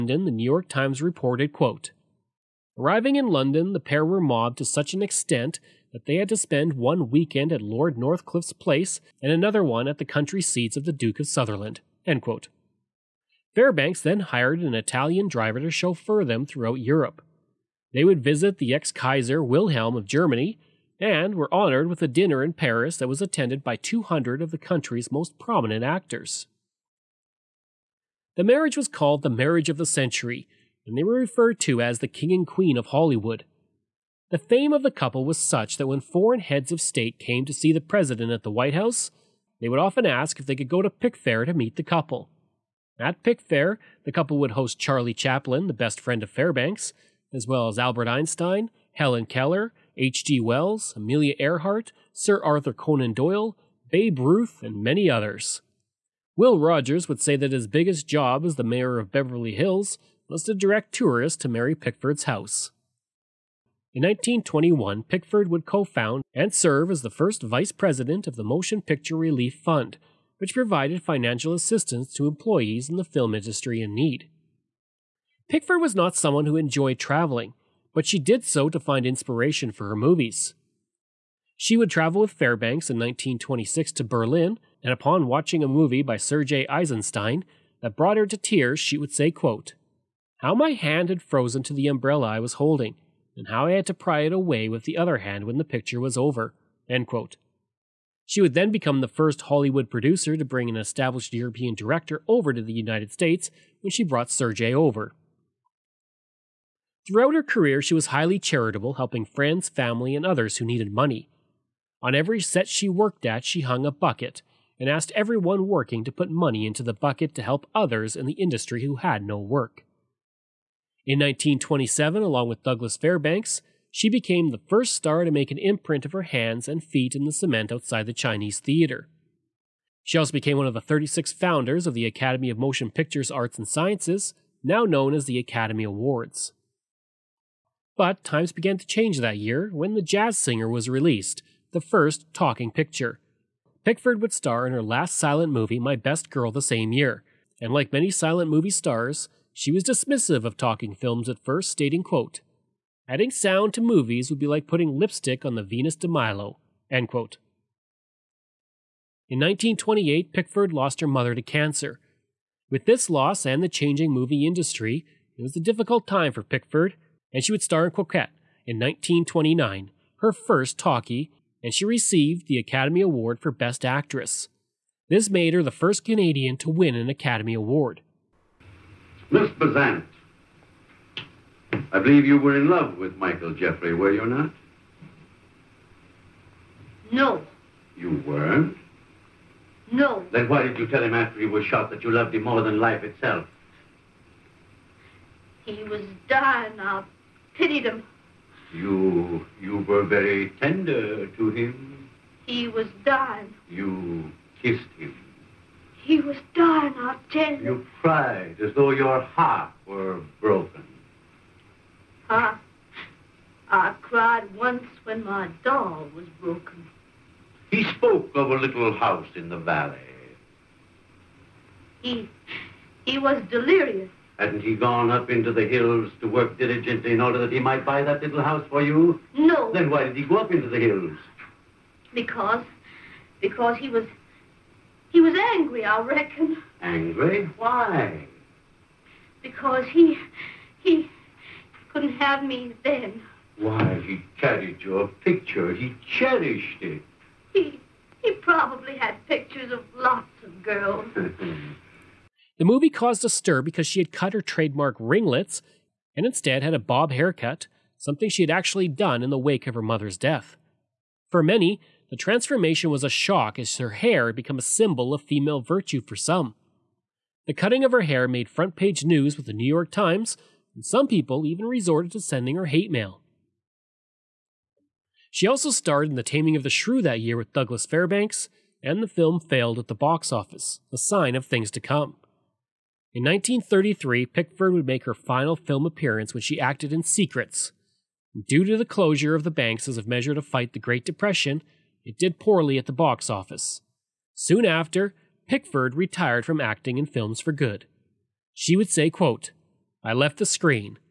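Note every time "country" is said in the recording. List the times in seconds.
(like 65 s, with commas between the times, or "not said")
10 s, 24 s.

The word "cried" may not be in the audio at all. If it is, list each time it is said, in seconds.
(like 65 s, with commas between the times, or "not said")
208 s, 214 s.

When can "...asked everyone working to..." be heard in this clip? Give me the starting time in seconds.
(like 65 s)
114 s.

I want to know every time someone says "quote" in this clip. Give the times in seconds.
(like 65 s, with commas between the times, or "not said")
1 s, 89 s, 97 s, 152 s, 157 s, 299 s.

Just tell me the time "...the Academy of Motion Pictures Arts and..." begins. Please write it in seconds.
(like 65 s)
131 s.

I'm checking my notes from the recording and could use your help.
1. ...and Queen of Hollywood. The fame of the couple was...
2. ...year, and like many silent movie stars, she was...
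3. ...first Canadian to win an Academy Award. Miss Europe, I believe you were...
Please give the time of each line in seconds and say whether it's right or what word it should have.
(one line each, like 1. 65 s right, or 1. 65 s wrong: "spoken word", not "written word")
1. 32 s right
2. 146 s right
3. 175 s wrong: "Besant", not "Europe".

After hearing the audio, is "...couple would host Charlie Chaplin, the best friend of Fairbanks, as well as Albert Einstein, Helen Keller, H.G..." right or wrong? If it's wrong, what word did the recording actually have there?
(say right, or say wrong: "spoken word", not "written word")
right.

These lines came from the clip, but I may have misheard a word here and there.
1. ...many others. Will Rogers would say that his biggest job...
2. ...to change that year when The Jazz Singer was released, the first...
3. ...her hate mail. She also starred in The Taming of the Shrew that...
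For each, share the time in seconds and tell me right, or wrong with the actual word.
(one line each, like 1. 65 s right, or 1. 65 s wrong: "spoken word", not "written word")
1. 54 s right
2. 138 s right
3. 272 s right.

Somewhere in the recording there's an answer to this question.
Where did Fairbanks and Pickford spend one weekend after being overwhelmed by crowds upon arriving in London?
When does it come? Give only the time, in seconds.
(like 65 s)
7 s.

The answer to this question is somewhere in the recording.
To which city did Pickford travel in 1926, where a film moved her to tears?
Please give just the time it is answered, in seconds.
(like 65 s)
84 s.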